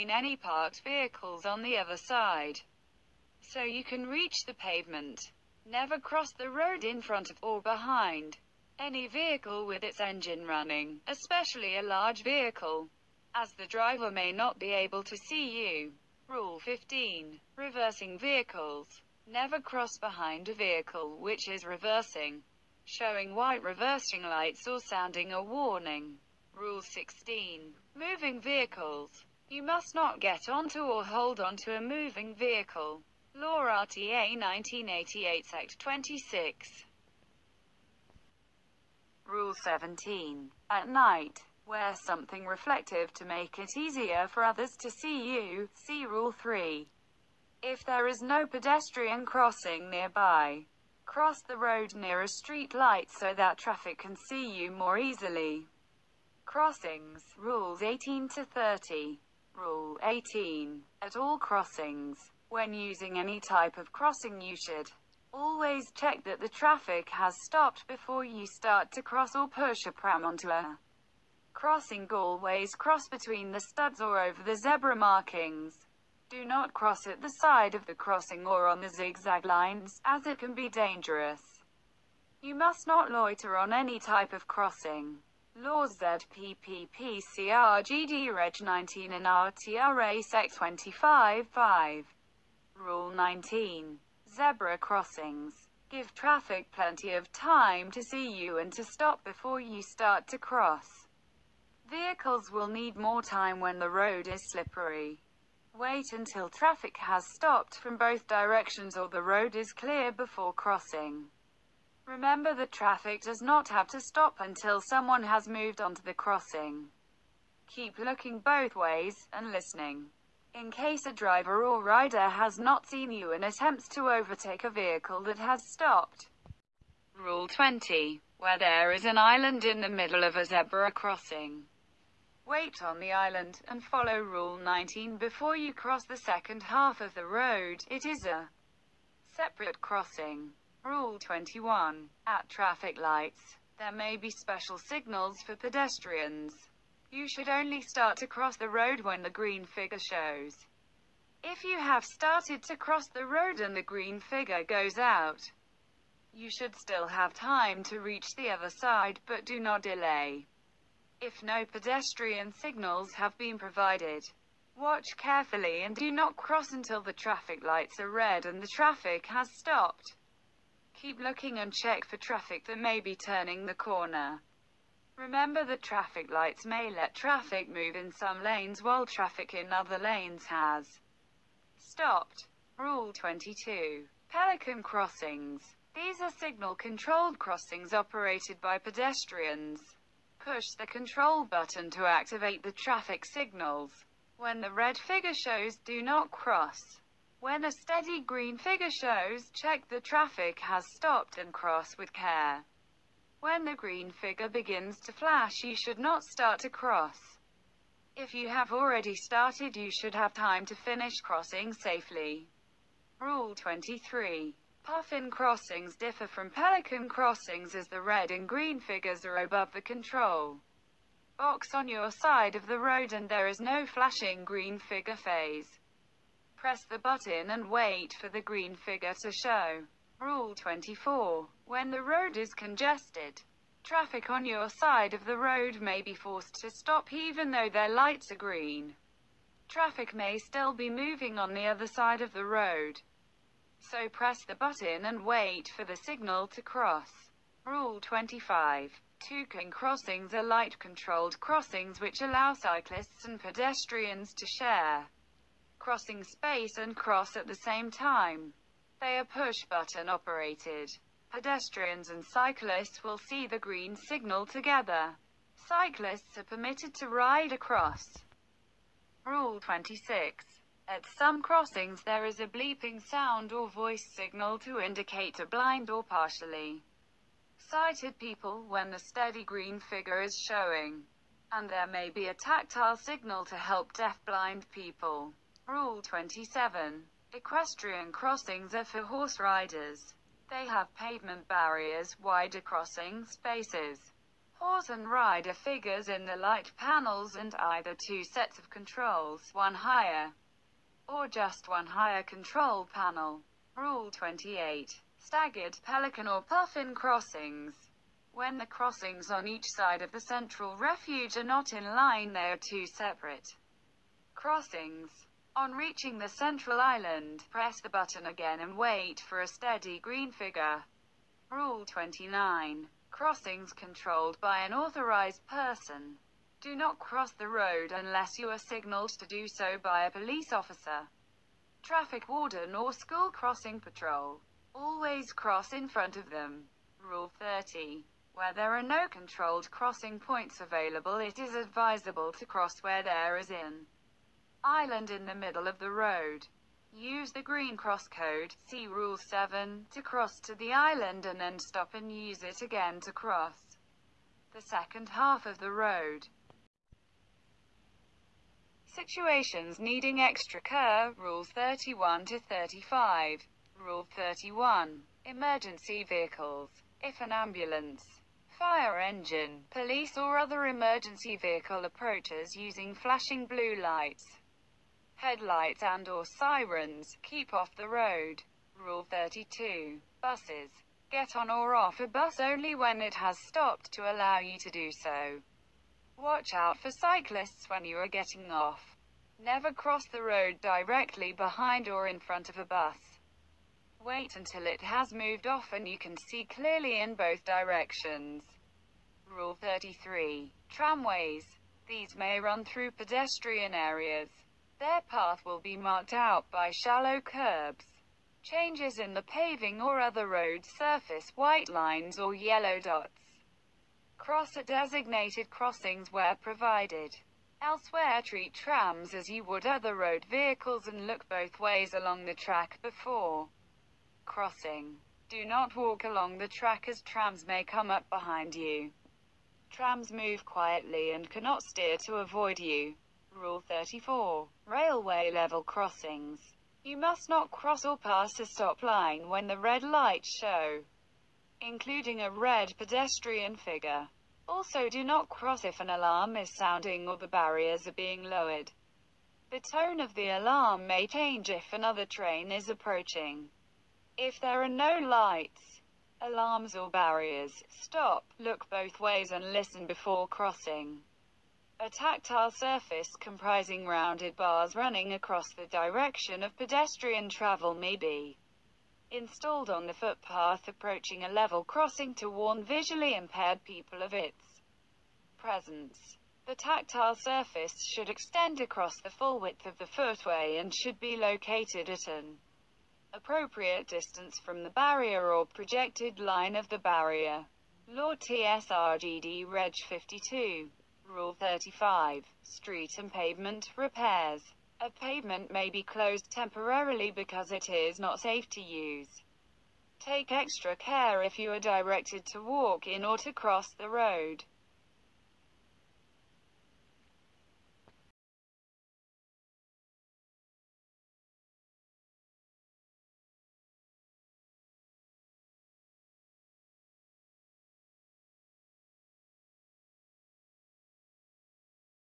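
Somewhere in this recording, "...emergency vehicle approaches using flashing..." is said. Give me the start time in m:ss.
6:10.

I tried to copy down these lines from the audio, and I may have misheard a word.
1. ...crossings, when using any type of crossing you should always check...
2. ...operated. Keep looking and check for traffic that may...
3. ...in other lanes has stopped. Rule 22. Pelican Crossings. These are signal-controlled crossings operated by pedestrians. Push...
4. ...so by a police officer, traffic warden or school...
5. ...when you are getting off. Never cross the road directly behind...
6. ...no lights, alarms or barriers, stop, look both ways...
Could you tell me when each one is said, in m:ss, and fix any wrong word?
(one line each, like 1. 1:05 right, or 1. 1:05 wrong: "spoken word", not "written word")
1. 1:01 right
2. 2:49 wrong: "stopped", not "operated"
3. 2:59 right
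4. 5:29 right
5. 6:27 right
6. 7:34 right.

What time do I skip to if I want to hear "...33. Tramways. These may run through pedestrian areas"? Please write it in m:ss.
6:39.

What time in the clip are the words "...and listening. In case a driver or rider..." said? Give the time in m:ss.
1:59.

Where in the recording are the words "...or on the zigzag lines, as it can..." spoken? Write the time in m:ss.
1:18.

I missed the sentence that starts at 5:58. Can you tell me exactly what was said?
Situations needing extra care, Rules 31 to 35.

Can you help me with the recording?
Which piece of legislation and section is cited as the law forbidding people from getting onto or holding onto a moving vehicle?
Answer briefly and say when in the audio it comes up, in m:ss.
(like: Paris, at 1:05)
RTA 1988 Sect 26, at 0:33.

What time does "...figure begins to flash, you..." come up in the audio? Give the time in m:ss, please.
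3:24.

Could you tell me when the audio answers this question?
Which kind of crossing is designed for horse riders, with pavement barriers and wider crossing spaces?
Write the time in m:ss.
4:47.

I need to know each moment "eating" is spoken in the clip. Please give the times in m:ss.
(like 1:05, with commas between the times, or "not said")
not said.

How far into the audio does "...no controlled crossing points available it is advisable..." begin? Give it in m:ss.
5:38.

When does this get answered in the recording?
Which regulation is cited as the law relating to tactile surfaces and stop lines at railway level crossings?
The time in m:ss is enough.
8:08.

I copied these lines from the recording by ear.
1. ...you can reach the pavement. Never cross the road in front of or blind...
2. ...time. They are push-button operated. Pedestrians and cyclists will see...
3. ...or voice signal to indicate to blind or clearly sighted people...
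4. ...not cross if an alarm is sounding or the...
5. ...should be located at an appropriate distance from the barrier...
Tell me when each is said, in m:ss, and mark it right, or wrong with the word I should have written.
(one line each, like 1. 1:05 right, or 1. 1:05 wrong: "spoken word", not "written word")
1. 0:03 wrong: "behind", not "blind"
2. 4:17 right
3. 4:33 wrong: "partially", not "clearly"
4. 7:25 right
5. 8:00 right.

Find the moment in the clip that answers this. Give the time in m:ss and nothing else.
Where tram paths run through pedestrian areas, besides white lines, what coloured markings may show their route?
6:52.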